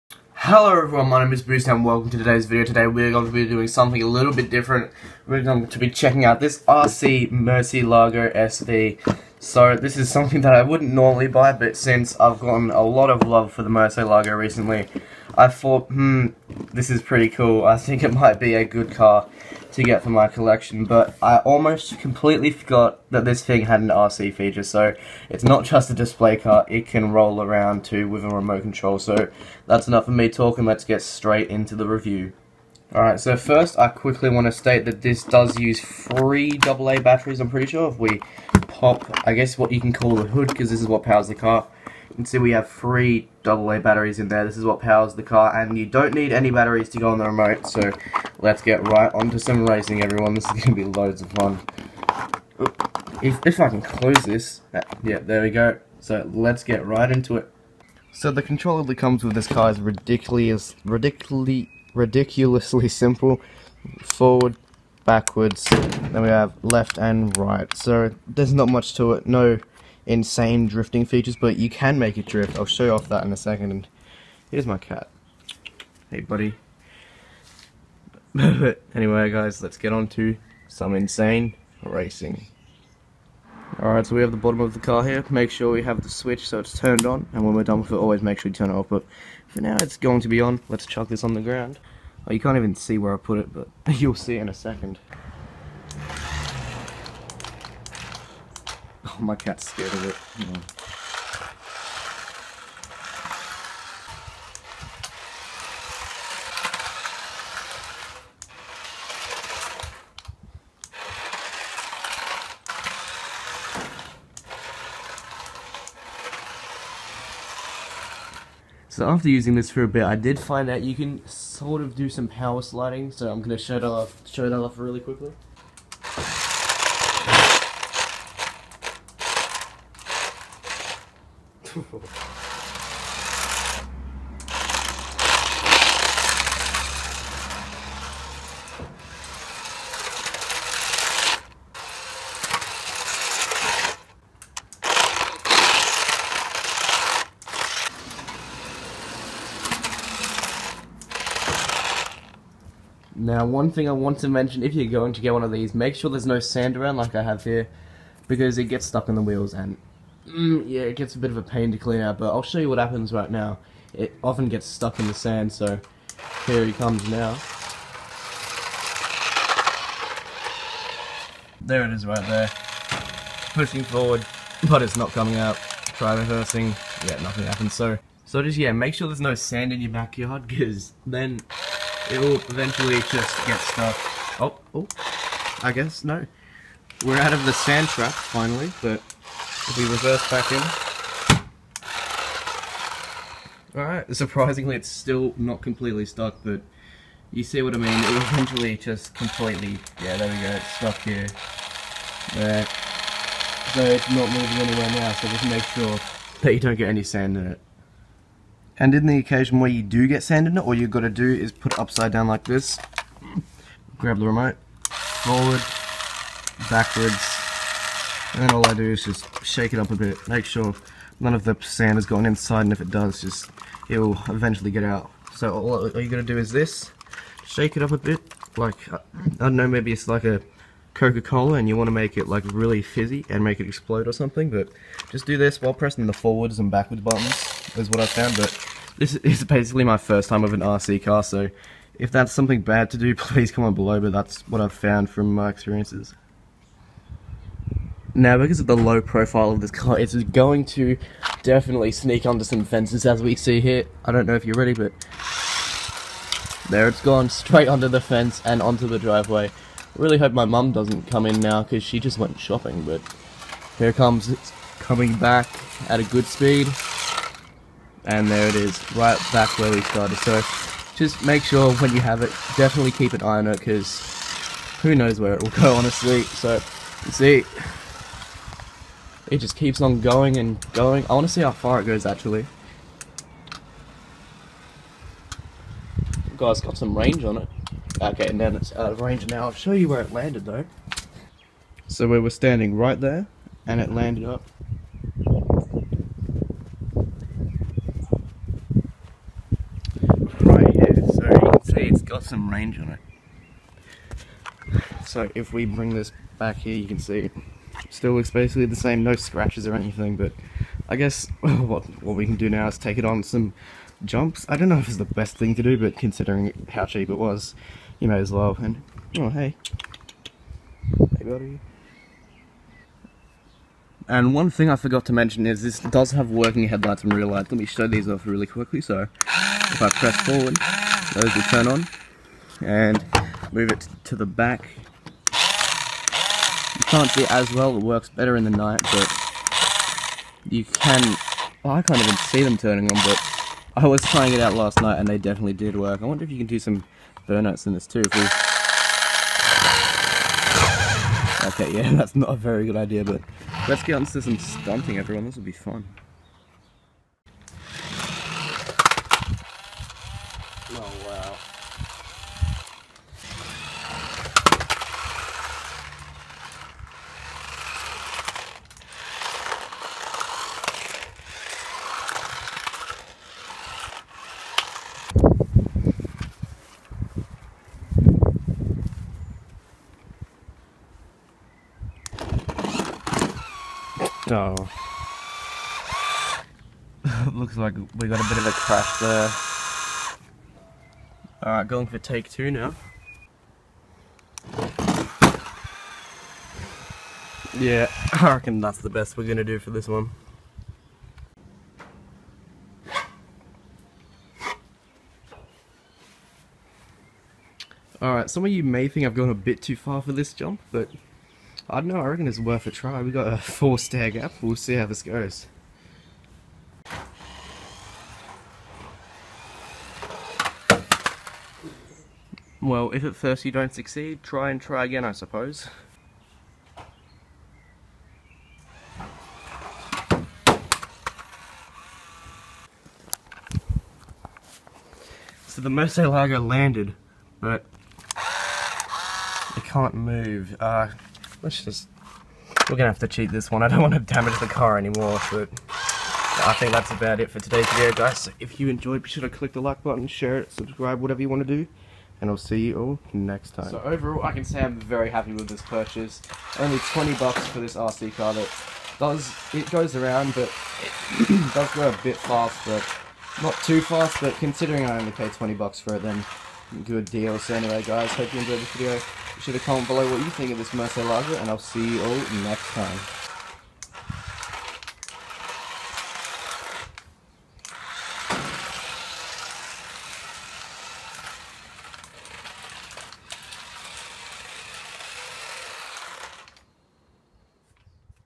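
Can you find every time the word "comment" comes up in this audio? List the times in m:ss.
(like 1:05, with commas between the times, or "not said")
4:03, 7:49.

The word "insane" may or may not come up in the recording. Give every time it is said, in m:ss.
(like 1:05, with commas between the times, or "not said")
1:10, 1:20.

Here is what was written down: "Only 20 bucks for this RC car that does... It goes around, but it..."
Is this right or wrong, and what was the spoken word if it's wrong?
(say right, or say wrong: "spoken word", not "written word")
right.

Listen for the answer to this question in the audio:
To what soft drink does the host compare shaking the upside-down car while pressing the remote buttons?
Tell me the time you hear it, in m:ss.
3:50.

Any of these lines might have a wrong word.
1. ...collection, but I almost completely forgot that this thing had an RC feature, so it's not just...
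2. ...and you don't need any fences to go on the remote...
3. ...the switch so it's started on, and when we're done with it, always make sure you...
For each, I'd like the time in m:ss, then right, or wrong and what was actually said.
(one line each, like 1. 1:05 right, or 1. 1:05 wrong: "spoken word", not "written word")
1. 0:20 right
2. 0:45 wrong: "batteries", not "fences"
3. 1:26 wrong: "turned", not "started".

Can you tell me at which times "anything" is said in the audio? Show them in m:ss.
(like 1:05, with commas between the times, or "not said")
5:09.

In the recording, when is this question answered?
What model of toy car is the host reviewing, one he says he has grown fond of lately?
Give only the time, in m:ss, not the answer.
0:07.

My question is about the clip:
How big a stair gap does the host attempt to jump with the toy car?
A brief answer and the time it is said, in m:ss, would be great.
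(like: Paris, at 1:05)
4 stairs, at 6:53.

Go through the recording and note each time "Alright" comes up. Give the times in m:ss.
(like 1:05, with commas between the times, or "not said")
0:32, 1:23, 3:13, 6:31, 6:48.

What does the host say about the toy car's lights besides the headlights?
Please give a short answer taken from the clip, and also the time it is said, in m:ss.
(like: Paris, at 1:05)
real lights, at 5:27.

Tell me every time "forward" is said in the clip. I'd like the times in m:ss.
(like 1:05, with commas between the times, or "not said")
1:04, 2:53, 3:34, 3:56, 5:30.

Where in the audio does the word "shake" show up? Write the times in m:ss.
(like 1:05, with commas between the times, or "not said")
3:39, 3:47.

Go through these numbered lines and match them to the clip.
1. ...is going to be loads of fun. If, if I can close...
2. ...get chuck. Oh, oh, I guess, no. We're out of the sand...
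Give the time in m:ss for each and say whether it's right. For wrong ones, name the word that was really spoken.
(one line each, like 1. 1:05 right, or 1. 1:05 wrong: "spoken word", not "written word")
1. 0:50 right
2. 3:03 wrong: "stuck", not "chuck".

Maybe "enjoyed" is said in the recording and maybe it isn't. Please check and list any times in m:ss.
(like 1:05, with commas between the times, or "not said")
7:28, 7:48.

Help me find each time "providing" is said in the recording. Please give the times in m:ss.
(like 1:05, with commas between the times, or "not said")
not said.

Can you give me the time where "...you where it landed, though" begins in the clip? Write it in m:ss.
4:49.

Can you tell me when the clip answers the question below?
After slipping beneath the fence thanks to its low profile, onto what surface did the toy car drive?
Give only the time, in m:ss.
4:18.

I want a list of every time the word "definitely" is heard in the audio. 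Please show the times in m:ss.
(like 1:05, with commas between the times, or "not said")
4:11, 4:32, 5:45.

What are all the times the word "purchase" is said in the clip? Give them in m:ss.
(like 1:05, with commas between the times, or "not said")
7:35.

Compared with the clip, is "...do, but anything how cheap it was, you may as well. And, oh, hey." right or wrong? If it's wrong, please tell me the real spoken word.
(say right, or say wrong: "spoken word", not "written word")
wrong: "considering", not "anything".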